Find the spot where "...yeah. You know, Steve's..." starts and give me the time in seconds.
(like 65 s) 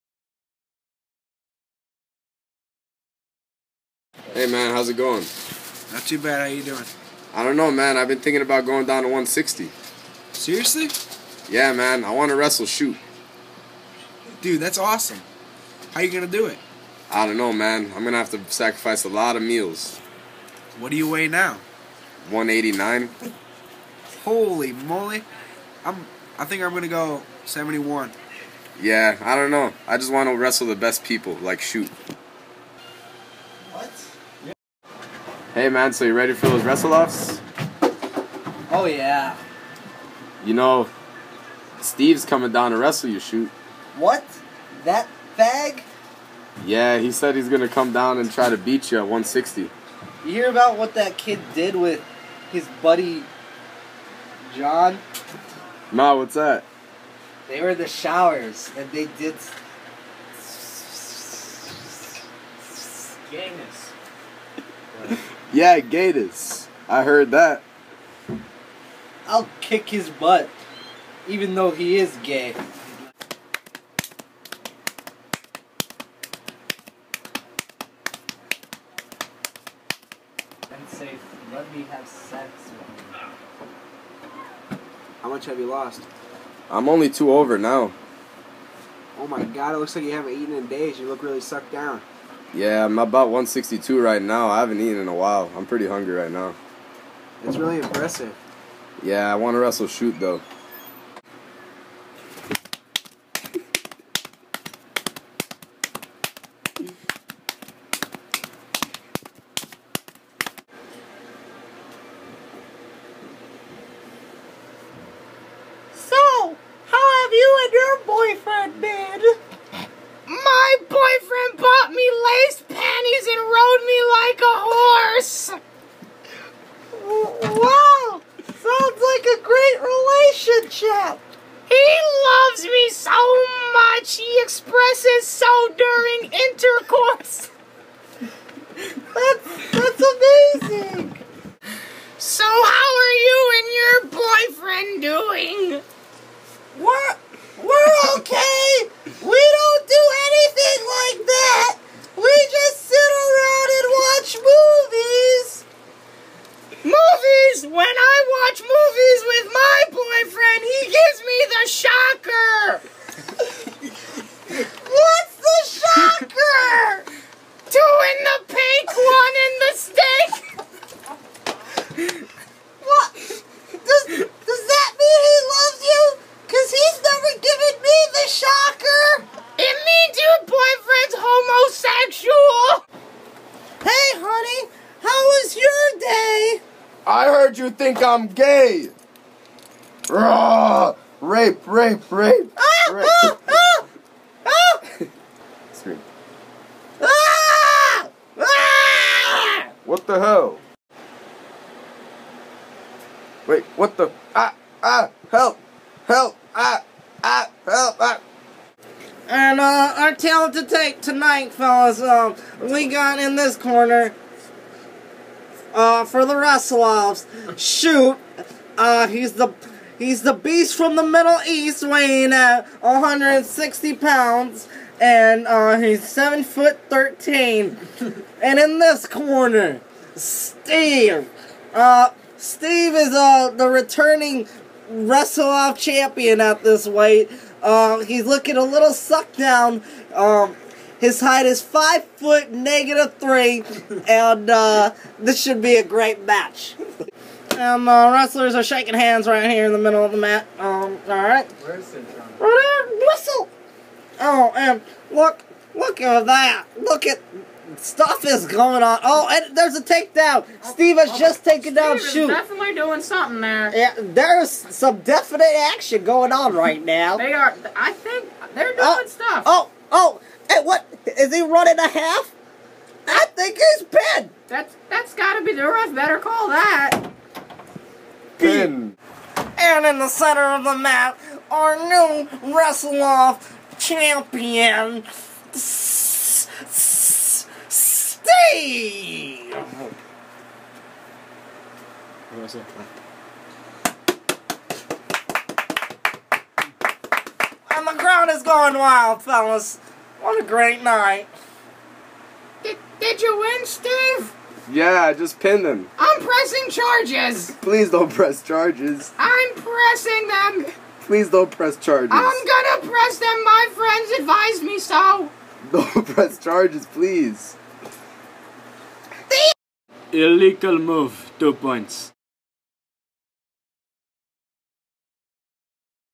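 38 s.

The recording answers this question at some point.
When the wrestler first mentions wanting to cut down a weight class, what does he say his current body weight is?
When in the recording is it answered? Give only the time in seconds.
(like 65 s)
22 s.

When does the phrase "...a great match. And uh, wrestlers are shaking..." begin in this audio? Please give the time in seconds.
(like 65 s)
245 s.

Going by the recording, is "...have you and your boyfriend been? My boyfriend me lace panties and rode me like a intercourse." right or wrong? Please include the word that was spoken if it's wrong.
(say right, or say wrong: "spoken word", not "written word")
wrong: "horse", not "intercourse".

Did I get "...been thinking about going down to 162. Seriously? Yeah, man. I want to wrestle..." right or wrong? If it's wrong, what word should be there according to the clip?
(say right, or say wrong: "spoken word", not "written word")
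wrong: "160", not "162".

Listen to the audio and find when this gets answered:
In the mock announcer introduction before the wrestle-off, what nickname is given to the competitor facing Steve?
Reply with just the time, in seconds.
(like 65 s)
220 s.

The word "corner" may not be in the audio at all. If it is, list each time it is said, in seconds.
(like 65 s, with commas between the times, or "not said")
213 s, 229 s.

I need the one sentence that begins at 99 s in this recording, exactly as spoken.
Yeah, I want to wrestle shoot though.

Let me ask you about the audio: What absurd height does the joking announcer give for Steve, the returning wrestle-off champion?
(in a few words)
five foot negative three.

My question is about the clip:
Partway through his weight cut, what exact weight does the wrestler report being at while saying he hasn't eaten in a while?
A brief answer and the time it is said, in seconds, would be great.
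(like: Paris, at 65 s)
162, at 93 s.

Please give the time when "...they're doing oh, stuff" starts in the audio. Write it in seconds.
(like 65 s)
268 s.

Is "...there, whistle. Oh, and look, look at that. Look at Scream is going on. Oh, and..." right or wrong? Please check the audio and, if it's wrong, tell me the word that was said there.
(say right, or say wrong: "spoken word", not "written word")
wrong: "Stuff", not "Scream".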